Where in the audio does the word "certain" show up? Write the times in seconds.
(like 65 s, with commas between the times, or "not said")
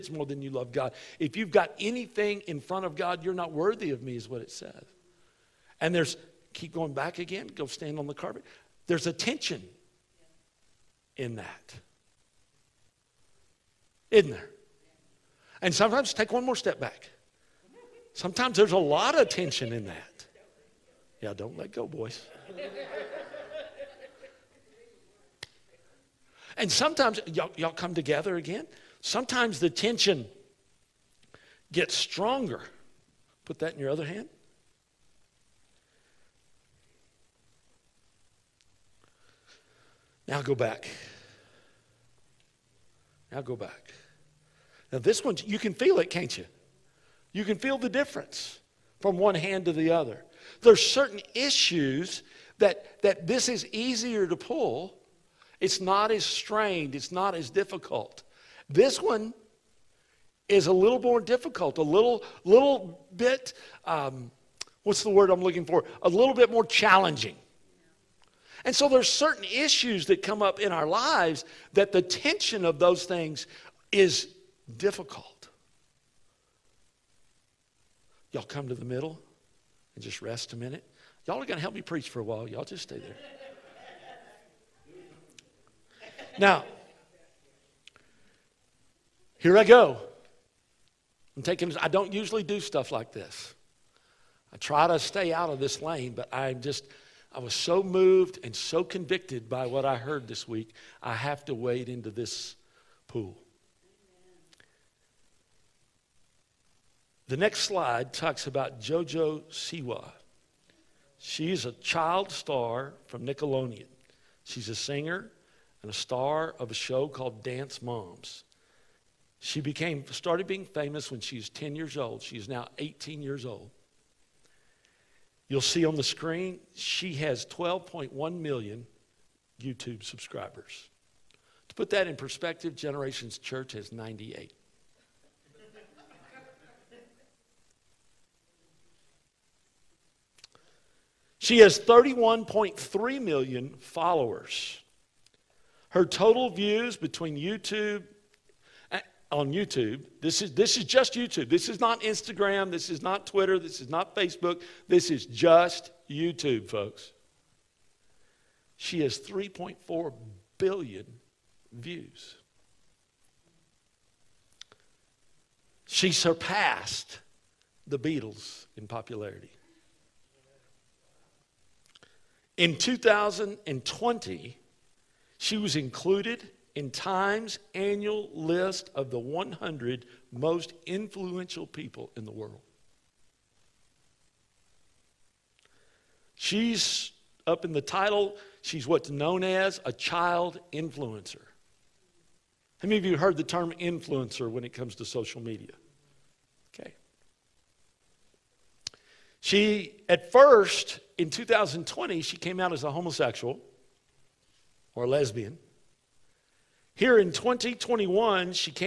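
50 s, 69 s.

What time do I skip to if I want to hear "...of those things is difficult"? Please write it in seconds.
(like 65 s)
72 s.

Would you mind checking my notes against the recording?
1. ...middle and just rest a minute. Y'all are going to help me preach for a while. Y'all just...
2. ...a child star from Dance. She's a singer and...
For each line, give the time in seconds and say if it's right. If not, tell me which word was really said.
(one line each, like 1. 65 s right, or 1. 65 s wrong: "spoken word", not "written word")
1. 78 s right
2. 111 s wrong: "Nickelodeon", not "Dance".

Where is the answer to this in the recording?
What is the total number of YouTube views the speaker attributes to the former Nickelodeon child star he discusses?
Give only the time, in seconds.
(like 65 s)
159 s.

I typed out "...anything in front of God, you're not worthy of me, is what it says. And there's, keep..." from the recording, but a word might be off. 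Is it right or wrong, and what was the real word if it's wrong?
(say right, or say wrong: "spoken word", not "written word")
right.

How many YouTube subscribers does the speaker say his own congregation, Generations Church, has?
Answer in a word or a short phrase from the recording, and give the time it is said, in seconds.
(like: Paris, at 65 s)
98, at 133 s.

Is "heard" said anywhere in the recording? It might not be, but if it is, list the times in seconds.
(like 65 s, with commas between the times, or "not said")
99 s, 193 s.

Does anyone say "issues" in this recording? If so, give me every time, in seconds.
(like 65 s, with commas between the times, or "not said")
51 s, 69 s.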